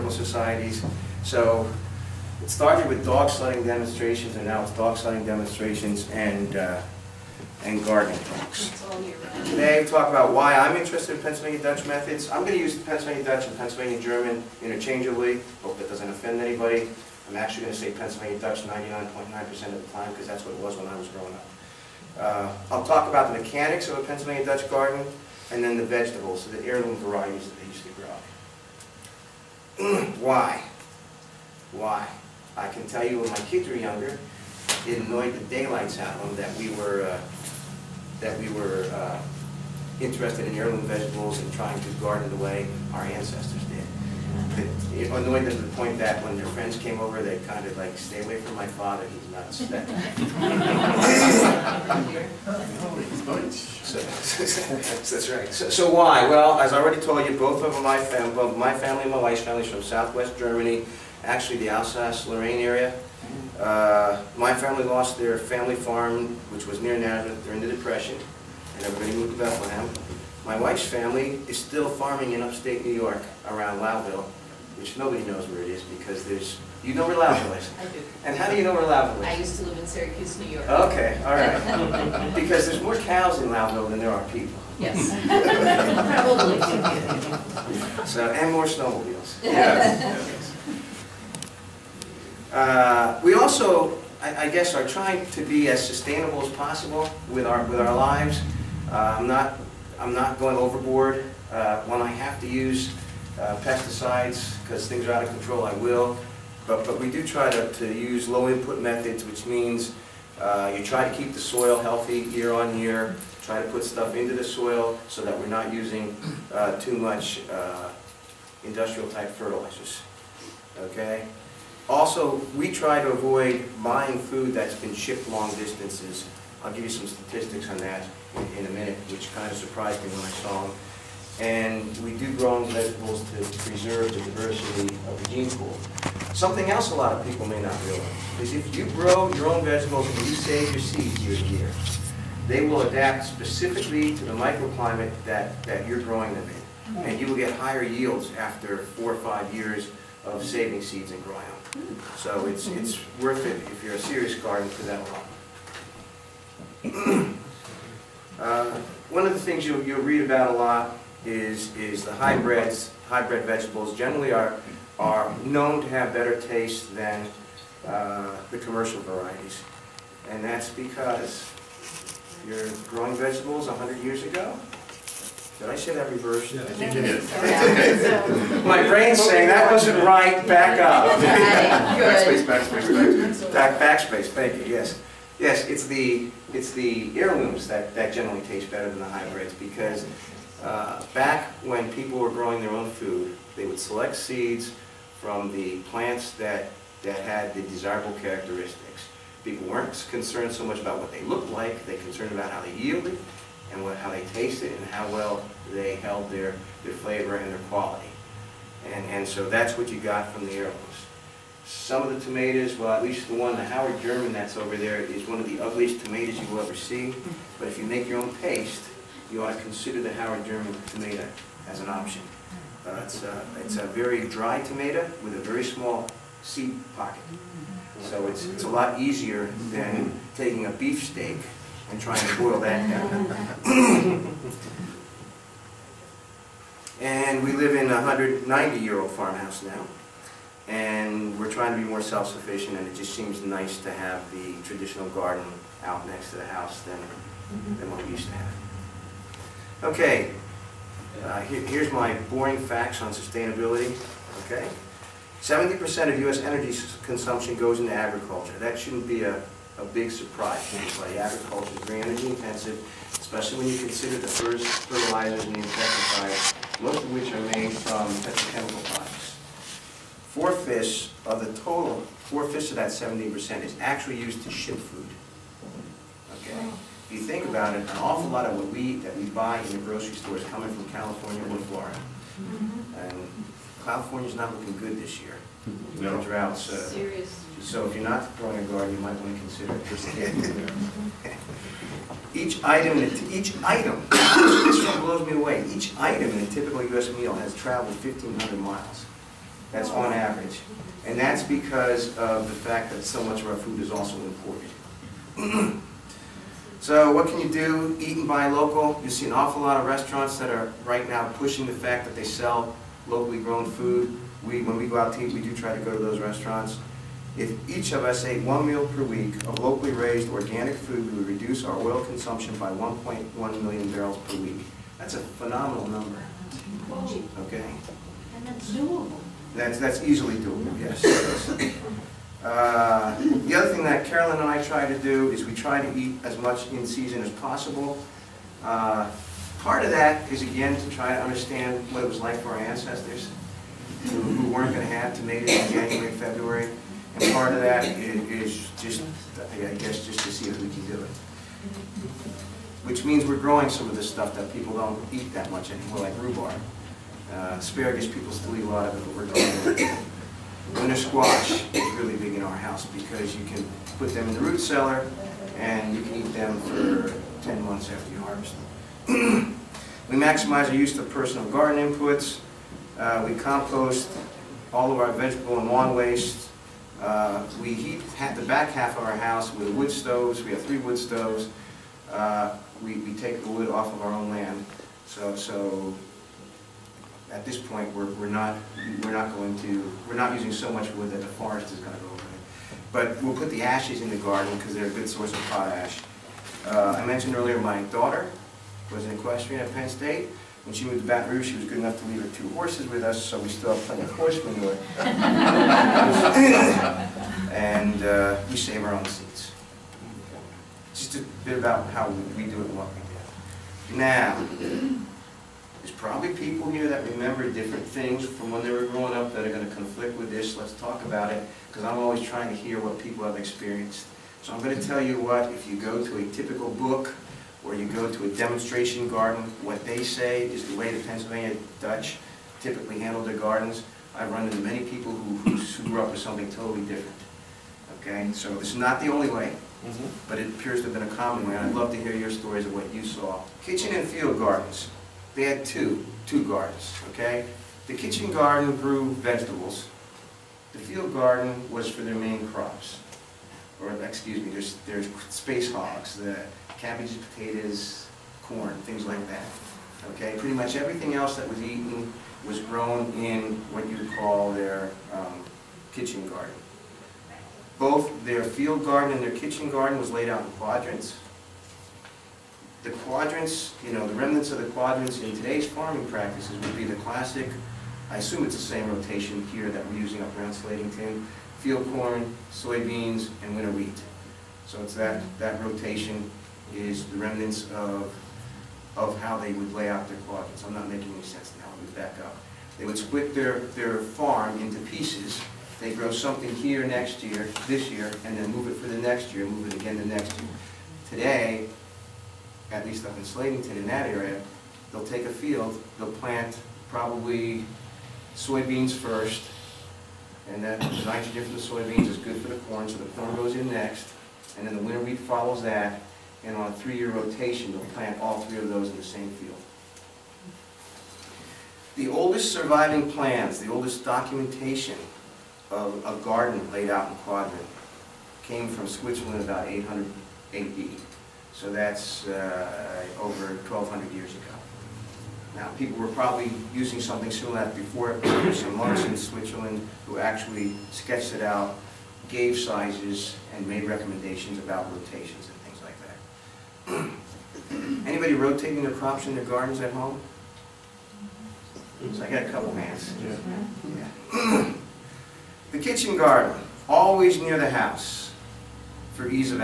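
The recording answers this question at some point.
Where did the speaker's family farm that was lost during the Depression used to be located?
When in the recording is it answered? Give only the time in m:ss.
1:06.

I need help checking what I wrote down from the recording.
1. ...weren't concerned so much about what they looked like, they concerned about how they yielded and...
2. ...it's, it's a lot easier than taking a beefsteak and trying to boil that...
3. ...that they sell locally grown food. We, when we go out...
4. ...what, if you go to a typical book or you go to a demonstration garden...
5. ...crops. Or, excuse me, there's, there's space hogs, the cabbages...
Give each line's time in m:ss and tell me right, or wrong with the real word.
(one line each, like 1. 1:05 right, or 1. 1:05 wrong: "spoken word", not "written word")
1. 3:19 right
2. 3:48 right
3. 5:12 right
4. 7:05 right
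5. 7:32 right.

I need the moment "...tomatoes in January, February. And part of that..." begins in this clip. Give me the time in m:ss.
5:45.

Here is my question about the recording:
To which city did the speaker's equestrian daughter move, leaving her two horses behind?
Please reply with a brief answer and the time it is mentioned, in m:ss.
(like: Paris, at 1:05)
Baton Rouge, at 6:41.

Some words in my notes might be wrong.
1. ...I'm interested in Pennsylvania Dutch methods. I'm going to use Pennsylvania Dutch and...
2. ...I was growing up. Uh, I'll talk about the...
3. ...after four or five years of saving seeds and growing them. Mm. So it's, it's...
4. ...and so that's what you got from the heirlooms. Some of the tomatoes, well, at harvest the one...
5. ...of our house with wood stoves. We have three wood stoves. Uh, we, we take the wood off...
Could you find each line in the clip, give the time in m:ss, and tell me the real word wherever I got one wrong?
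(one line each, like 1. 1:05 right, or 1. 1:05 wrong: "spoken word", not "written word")
1. 0:10 right
2. 0:20 right
3. 2:28 right
4. 3:29 wrong: "least", not "harvest"
5. 6:18 right.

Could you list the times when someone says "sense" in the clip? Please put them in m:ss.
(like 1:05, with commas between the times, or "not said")
8:11.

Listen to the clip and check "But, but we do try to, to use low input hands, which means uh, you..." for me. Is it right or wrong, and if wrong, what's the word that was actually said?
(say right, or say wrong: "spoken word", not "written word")
wrong: "methods", not "hands".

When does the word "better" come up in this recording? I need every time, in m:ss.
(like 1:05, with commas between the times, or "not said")
2:46, 3:08.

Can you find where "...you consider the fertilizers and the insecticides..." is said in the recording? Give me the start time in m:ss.
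4:23.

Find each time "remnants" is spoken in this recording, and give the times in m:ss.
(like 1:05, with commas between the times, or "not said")
7:54, 8:07.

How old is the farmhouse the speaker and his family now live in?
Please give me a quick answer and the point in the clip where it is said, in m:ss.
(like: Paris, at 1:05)
190 years, at 3:57.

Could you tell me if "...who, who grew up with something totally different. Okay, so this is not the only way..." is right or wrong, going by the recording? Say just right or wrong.
right.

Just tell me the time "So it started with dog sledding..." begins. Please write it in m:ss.
0:01.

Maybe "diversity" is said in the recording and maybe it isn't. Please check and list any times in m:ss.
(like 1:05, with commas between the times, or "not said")
2:14.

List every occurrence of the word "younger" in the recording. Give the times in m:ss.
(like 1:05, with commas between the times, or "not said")
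0:33.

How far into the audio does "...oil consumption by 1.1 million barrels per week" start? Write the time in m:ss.
5:21.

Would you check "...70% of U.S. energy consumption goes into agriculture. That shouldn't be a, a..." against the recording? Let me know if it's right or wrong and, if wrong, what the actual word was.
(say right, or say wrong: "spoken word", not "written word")
right.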